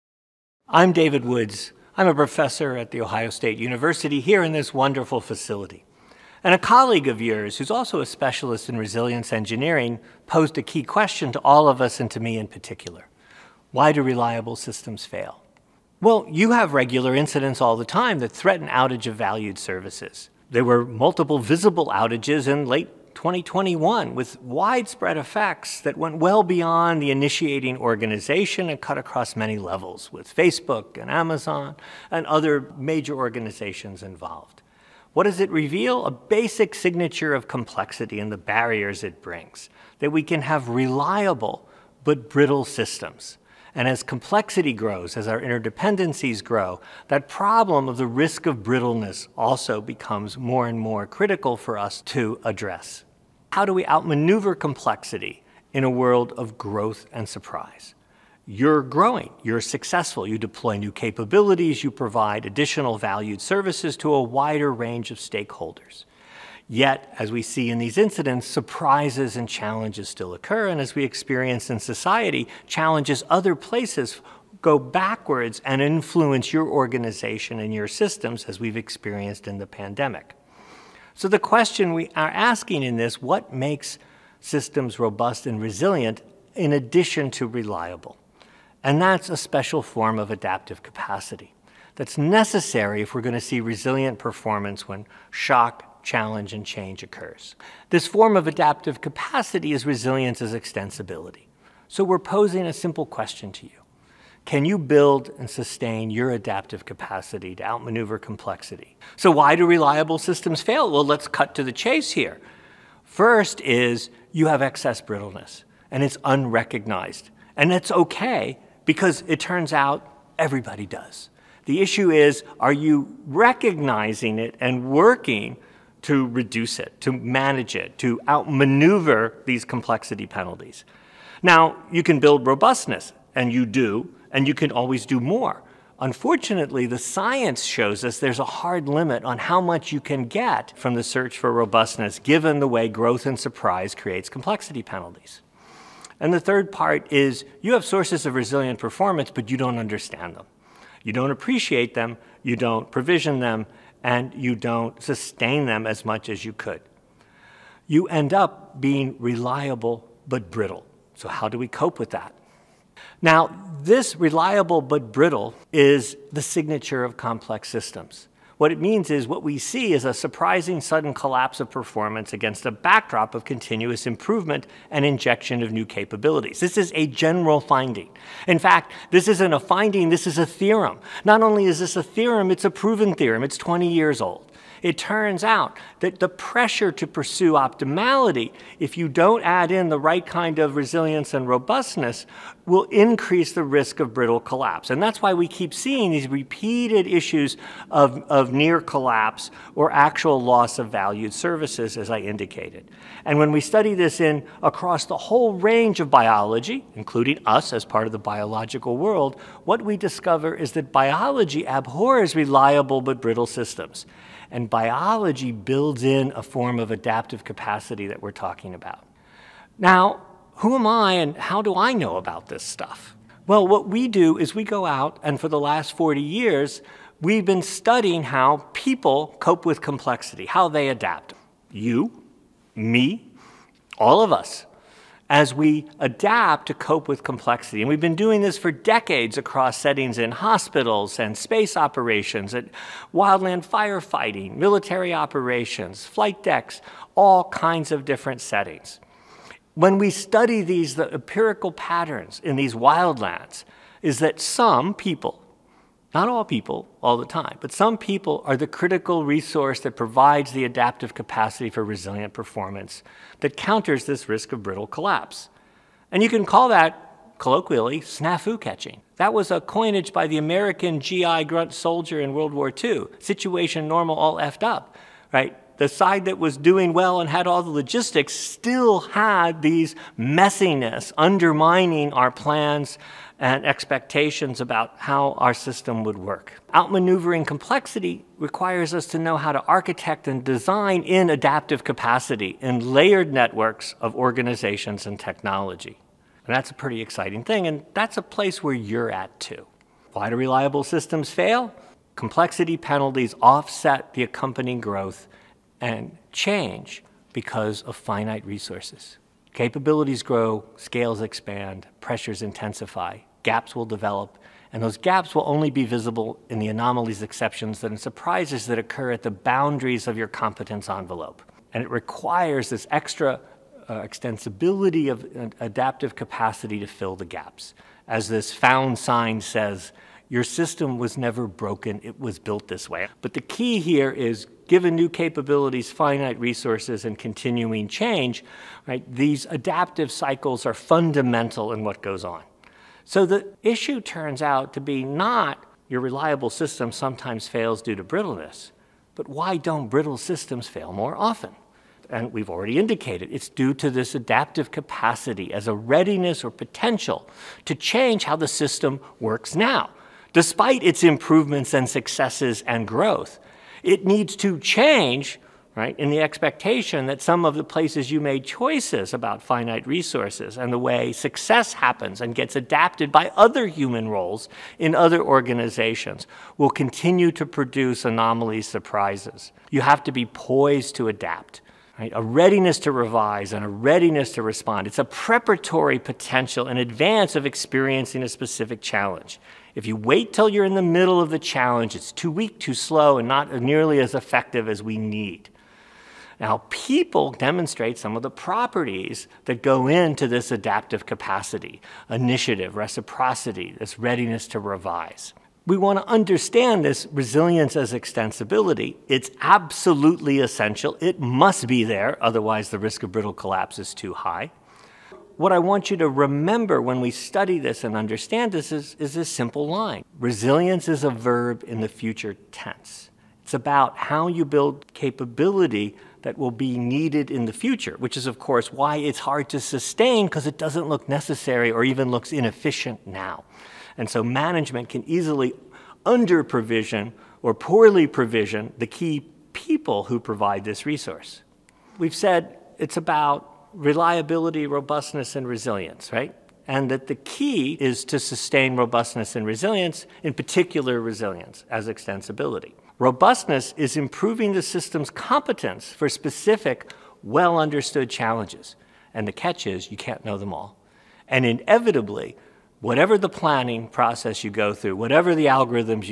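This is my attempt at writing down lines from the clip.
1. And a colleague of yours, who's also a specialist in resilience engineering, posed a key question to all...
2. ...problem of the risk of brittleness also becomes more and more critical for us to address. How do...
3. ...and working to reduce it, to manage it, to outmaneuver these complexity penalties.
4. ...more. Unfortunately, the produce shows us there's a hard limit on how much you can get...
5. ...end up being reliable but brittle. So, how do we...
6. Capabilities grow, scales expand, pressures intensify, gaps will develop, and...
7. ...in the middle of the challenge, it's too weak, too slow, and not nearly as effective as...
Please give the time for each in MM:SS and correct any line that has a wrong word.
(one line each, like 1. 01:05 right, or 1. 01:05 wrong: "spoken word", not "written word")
1. 00:06 right
2. 00:47 right
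3. 02:04 right
4. 02:15 wrong: "science", not "produce"
5. 02:38 right
6. 05:09 right
7. 06:30 right.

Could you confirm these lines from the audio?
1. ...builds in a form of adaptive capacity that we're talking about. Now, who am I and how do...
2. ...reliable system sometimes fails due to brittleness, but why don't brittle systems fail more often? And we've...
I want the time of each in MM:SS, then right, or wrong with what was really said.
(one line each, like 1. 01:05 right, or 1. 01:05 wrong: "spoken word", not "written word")
1. 03:35 right
2. 05:46 right.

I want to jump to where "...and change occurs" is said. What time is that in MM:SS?
01:36.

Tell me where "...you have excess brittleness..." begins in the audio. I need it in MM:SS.
01:54.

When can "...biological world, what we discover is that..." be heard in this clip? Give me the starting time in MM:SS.
03:28.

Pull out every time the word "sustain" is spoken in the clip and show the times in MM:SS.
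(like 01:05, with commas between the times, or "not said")
01:45, 02:35, 07:09, 07:28.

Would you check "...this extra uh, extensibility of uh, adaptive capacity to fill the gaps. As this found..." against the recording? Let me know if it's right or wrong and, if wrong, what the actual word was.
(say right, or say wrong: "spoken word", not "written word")
right.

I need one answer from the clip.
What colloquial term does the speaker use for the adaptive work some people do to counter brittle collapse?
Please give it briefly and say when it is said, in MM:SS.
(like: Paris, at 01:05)
snafu catching, at 04:28.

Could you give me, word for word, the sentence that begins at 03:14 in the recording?
And that's why we keep seeing these repeated issues of, of near collapse or actual loss of valued services, as I indicated.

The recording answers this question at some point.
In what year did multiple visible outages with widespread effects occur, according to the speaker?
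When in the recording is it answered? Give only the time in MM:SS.
00:22.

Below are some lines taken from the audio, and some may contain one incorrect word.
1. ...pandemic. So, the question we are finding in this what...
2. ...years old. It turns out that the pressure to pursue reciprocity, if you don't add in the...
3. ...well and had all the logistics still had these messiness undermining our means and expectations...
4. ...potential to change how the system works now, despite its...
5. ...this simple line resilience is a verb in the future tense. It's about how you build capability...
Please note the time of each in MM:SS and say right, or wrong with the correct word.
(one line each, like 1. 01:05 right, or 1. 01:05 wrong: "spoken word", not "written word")
1. 01:19 wrong: "asking", not "finding"
2. 03:03 wrong: "optimality", not "reciprocity"
3. 04:36 wrong: "plans", not "means"
4. 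05:56 right
5. 06:59 right.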